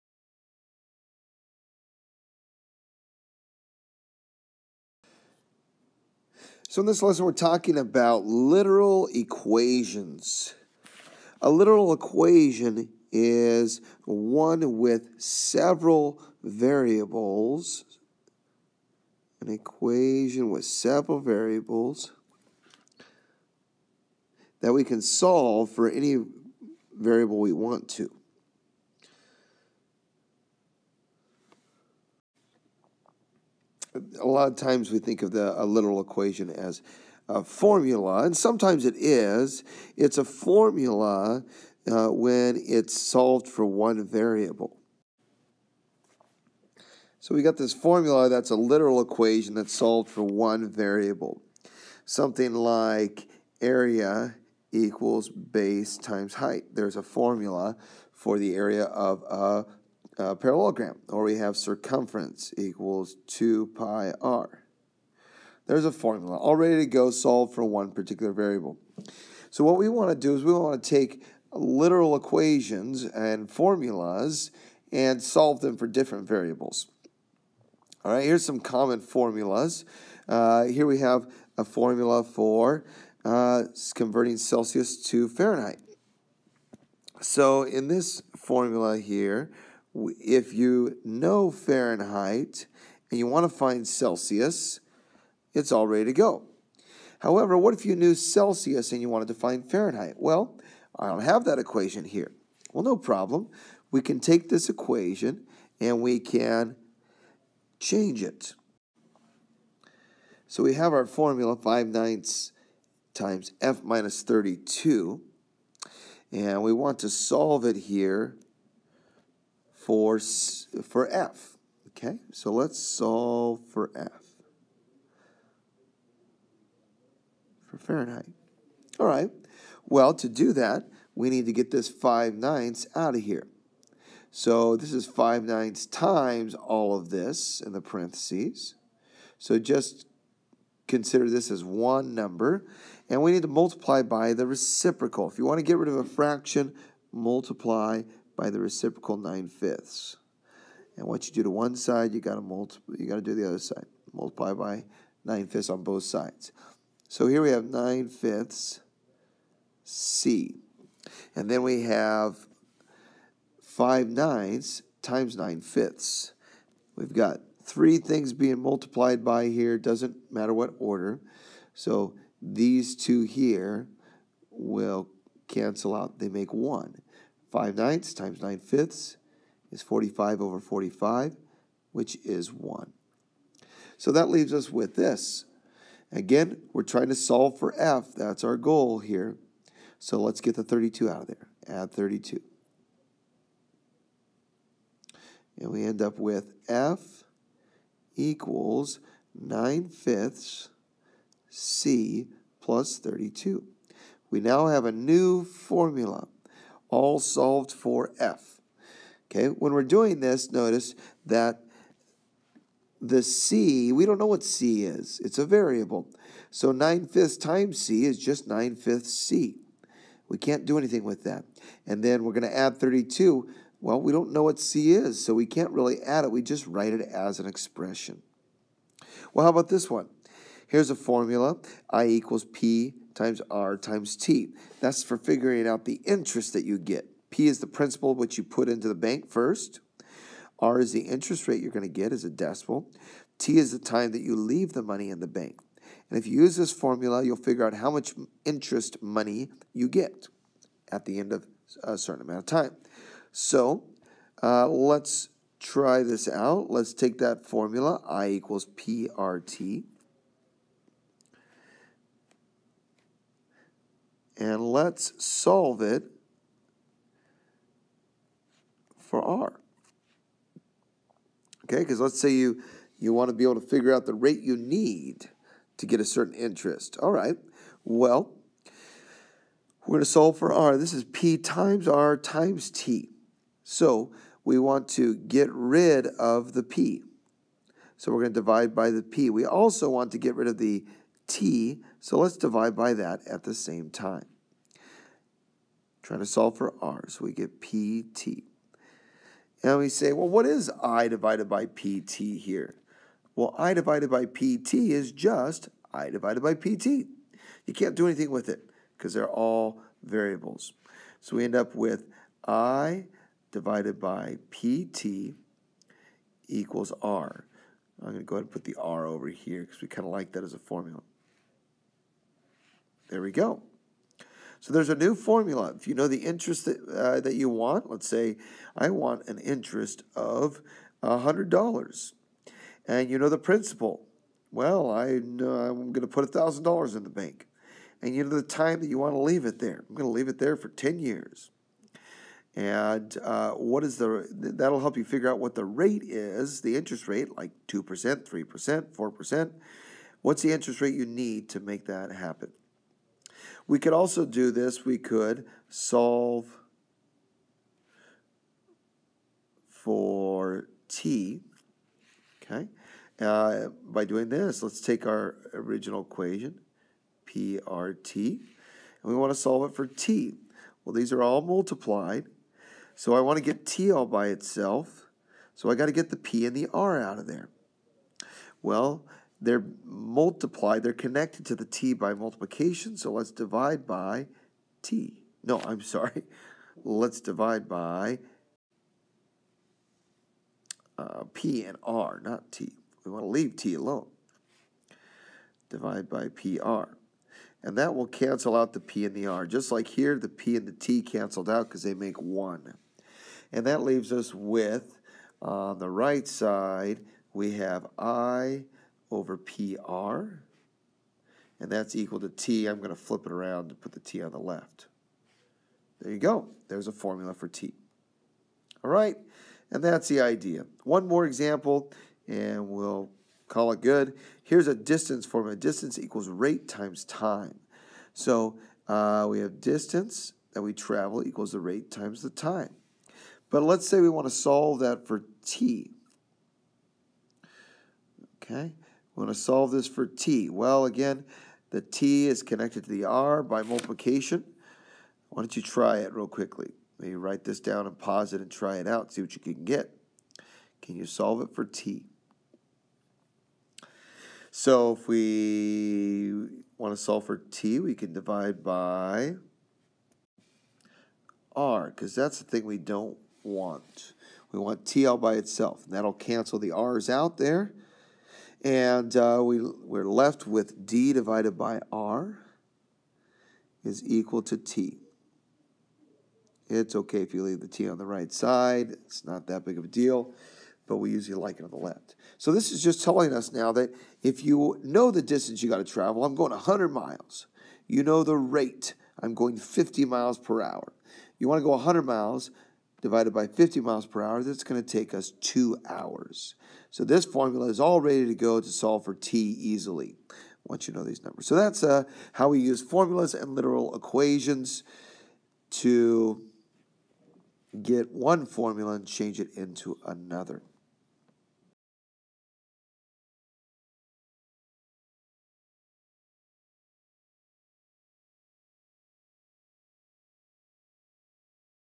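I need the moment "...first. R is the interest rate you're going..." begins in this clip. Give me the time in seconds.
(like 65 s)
239 s.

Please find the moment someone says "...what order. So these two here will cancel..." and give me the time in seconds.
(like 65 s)
170 s.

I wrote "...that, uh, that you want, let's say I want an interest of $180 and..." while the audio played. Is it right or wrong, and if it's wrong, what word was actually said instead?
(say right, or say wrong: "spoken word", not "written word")
wrong: "100", not "180".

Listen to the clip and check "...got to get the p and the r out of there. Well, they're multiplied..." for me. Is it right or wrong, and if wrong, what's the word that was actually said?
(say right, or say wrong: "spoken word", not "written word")
right.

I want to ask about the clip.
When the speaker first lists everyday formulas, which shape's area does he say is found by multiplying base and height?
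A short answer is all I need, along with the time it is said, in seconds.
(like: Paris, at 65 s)
parallelogram, at 60 s.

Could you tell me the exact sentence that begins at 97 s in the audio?
However, what if you knew Celsius and you wanted to find Fahrenheit?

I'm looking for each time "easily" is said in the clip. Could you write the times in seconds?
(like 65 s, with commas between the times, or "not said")
499 s.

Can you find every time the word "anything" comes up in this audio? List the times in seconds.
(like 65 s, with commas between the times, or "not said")
220 s, 308 s.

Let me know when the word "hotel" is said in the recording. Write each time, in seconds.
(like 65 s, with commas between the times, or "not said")
not said.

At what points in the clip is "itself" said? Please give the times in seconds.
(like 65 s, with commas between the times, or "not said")
374 s, 465 s.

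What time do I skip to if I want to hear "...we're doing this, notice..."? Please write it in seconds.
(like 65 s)
209 s.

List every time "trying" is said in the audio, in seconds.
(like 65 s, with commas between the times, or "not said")
186 s, 296 s.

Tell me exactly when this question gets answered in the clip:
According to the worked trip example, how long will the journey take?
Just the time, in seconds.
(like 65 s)
495 s.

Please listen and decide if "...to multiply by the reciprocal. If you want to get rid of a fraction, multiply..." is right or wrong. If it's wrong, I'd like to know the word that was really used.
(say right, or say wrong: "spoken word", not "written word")
right.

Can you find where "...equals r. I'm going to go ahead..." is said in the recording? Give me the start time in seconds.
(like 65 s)
316 s.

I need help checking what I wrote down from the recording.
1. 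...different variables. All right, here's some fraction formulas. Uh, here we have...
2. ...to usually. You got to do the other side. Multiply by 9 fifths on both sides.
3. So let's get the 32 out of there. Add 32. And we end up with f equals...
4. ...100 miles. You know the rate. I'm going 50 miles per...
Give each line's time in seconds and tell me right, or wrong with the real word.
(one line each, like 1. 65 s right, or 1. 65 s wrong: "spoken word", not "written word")
1. 75 s wrong: "common", not "fraction"
2. 152 s wrong: "multiply", not "usually"
3. 189 s right
4. 486 s right.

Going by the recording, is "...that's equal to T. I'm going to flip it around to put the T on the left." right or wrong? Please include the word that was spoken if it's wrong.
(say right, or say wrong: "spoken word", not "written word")
right.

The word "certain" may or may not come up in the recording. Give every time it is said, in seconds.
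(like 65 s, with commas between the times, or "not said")
251 s, 276 s.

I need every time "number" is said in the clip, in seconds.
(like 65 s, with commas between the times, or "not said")
142 s, 501 s.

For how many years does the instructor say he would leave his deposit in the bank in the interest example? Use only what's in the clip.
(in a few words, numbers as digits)
10 years.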